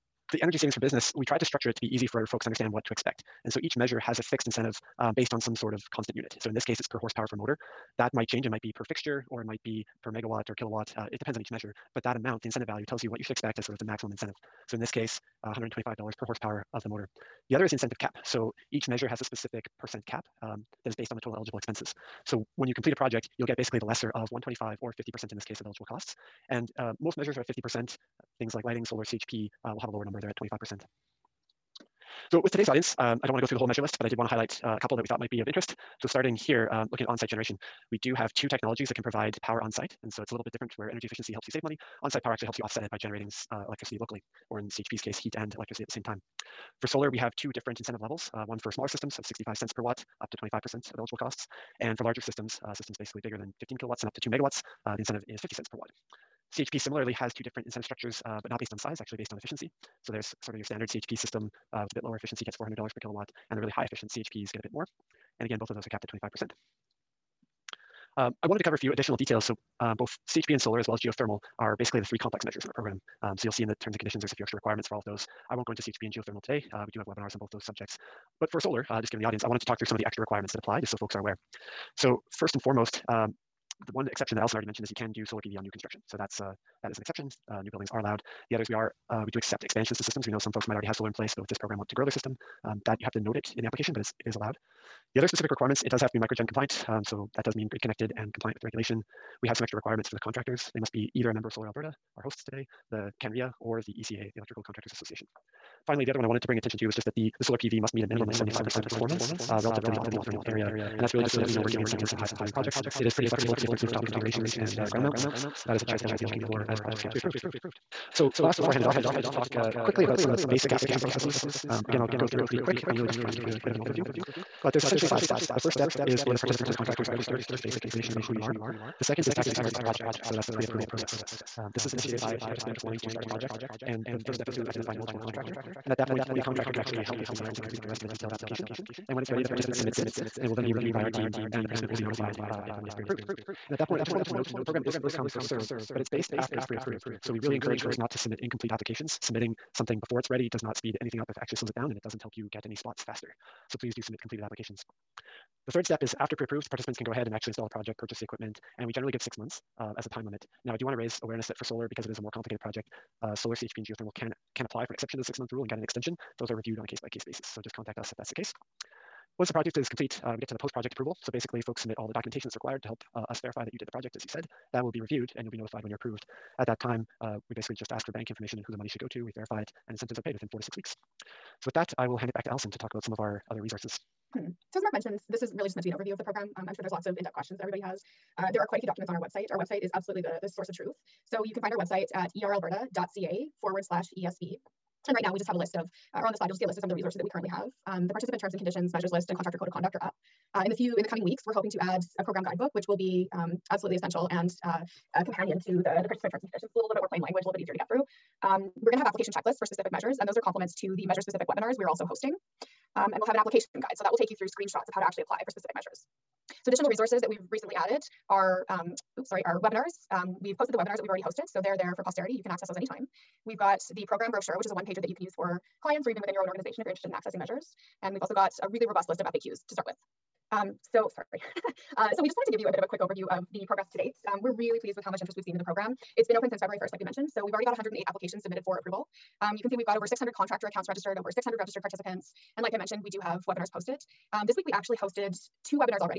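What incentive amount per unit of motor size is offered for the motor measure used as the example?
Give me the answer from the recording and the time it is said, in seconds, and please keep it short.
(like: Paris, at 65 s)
$125 per horsepower, at 15 s.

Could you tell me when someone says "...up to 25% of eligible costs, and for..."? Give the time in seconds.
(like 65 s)
50 s.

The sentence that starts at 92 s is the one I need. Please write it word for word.
Um, that you have to note it in the application, but it's, it is allowed.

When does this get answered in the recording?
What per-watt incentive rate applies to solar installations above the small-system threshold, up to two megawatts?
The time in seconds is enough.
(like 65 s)
55 s.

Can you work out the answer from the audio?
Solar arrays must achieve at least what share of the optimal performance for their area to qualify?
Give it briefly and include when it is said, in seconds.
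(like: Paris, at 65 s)
75%, at 108 s.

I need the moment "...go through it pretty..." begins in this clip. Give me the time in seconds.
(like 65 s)
122 s.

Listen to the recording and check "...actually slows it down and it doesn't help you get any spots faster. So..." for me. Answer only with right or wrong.
right.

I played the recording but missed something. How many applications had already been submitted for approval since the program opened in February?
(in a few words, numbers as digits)
108.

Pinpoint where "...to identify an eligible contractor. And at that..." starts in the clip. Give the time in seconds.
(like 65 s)
134 s.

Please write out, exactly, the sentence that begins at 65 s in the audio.
And again, both of those are capped at 25%.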